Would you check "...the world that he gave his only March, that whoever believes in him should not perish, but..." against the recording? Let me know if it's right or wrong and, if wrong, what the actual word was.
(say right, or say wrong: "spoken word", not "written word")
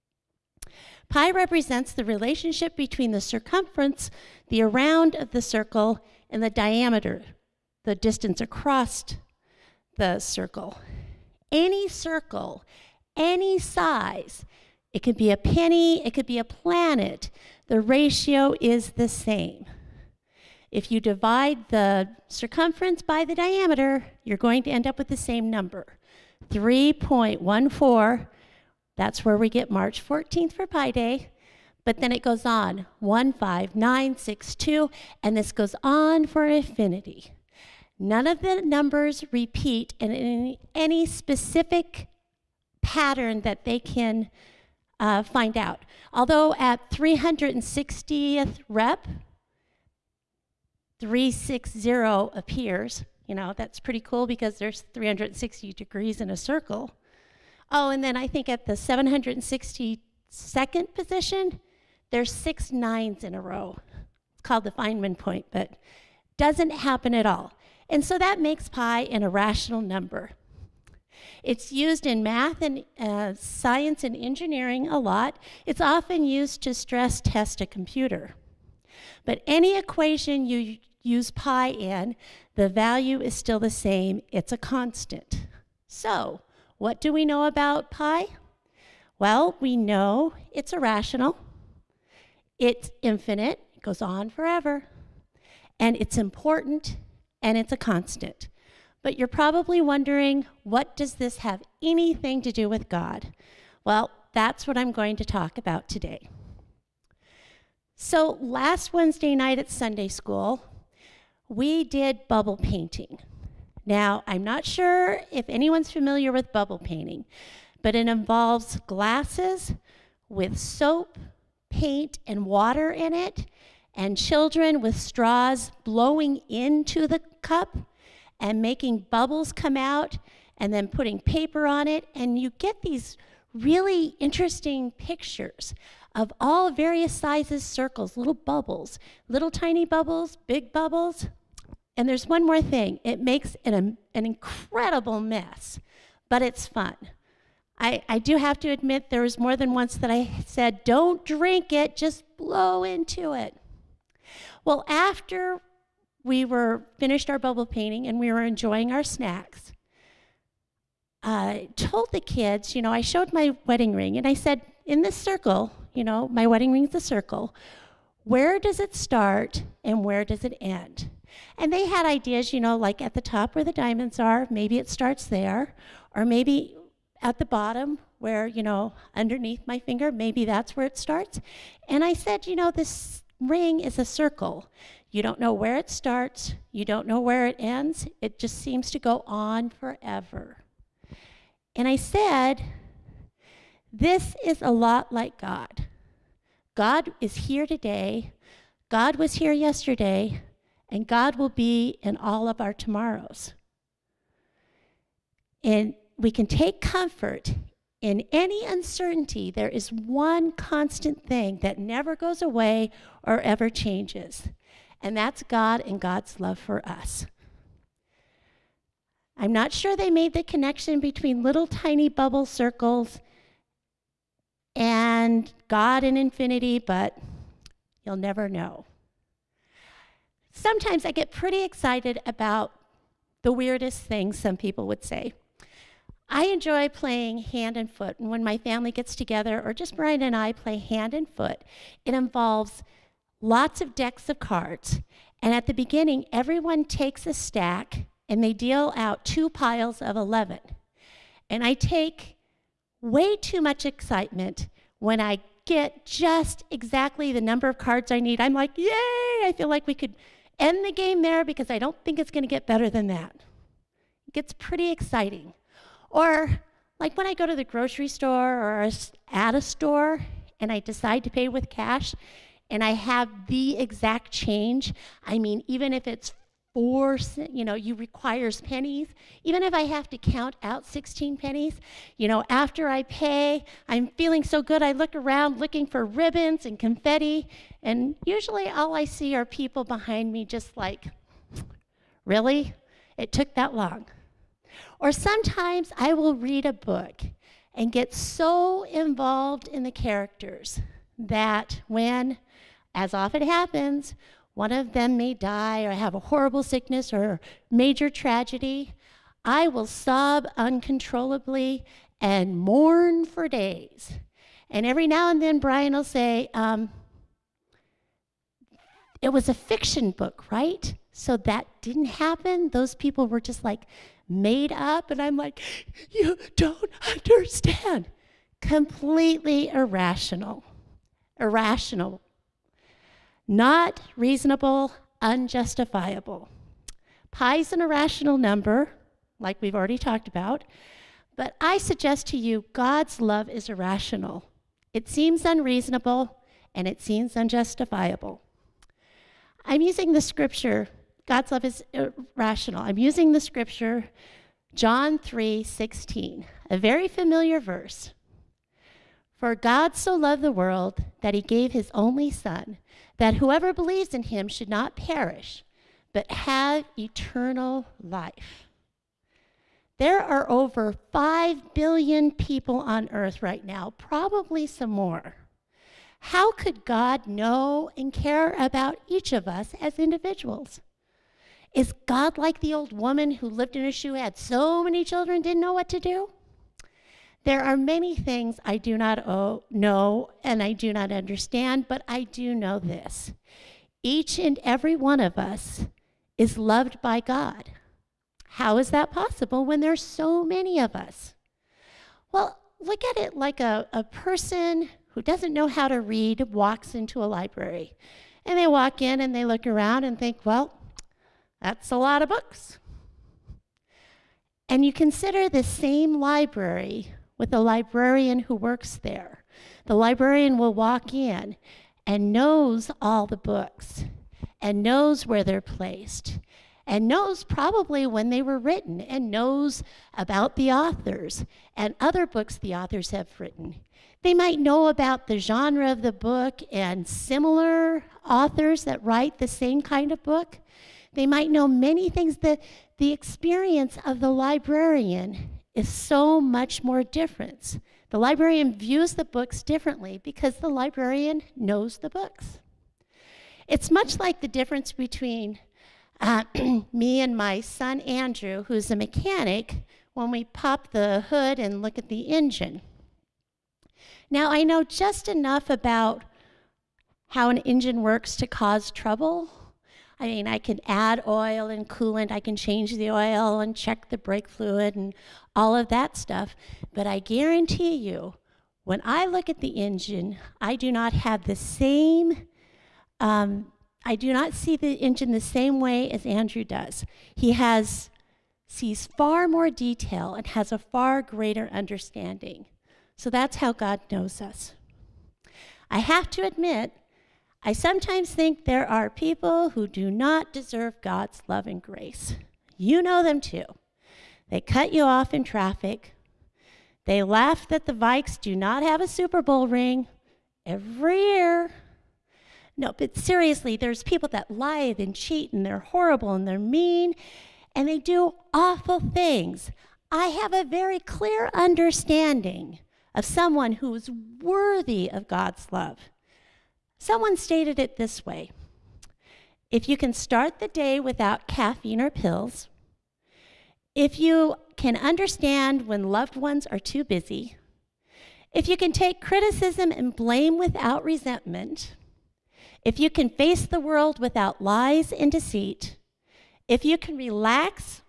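wrong: "Son", not "March".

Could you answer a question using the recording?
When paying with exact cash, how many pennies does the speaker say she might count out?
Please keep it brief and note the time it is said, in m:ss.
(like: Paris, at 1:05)
16, at 4:40.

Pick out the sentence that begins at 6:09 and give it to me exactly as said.
There are over 5 billion people on earth right now, probably some more.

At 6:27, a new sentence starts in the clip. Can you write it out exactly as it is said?
There are many things I do not know and I do not understand, but I do know this.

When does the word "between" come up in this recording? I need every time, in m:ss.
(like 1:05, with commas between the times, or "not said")
0:02, 3:40, 7:34.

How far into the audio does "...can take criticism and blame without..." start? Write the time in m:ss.
8:58.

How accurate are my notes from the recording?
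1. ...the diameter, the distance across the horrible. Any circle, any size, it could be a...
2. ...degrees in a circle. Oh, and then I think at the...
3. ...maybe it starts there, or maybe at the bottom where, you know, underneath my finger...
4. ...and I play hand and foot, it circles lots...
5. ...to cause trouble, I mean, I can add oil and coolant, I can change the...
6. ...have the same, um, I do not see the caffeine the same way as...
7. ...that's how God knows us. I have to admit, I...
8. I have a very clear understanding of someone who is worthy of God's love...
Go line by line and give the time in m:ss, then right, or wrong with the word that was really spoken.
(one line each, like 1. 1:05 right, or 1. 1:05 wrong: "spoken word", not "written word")
1. 0:06 wrong: "circle", not "horrible"
2. 0:55 right
3. 2:54 right
4. 4:00 wrong: "involves", not "circles"
5. 7:48 right
6. 8:01 wrong: "engine", not "caffeine"
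7. 8:13 right
8. 8:40 right.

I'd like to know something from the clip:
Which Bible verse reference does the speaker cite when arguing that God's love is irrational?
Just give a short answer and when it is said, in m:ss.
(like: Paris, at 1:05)
John 3:16, at 5:54.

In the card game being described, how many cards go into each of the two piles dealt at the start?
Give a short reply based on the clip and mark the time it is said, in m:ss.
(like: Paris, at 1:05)
11, at 4:10.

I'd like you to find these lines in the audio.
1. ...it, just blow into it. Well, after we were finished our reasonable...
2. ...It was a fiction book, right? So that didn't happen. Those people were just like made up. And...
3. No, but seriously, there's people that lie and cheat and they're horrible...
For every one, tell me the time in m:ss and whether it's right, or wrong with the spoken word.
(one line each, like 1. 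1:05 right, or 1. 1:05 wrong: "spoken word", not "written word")
1. 2:31 wrong: "bubble", not "reasonable"
2. 5:19 right
3. 8:32 right.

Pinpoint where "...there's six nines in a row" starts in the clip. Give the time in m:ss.
1:02.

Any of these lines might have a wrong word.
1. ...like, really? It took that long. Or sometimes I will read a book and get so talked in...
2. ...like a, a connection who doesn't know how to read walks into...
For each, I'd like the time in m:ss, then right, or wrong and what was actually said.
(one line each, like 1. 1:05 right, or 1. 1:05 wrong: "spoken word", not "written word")
1. 4:50 wrong: "involved", not "talked"
2. 6:43 wrong: "person", not "connection".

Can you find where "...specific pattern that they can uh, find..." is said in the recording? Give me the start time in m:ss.
0:41.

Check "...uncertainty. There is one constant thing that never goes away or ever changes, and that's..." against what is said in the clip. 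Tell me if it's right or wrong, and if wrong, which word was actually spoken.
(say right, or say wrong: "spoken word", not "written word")
right.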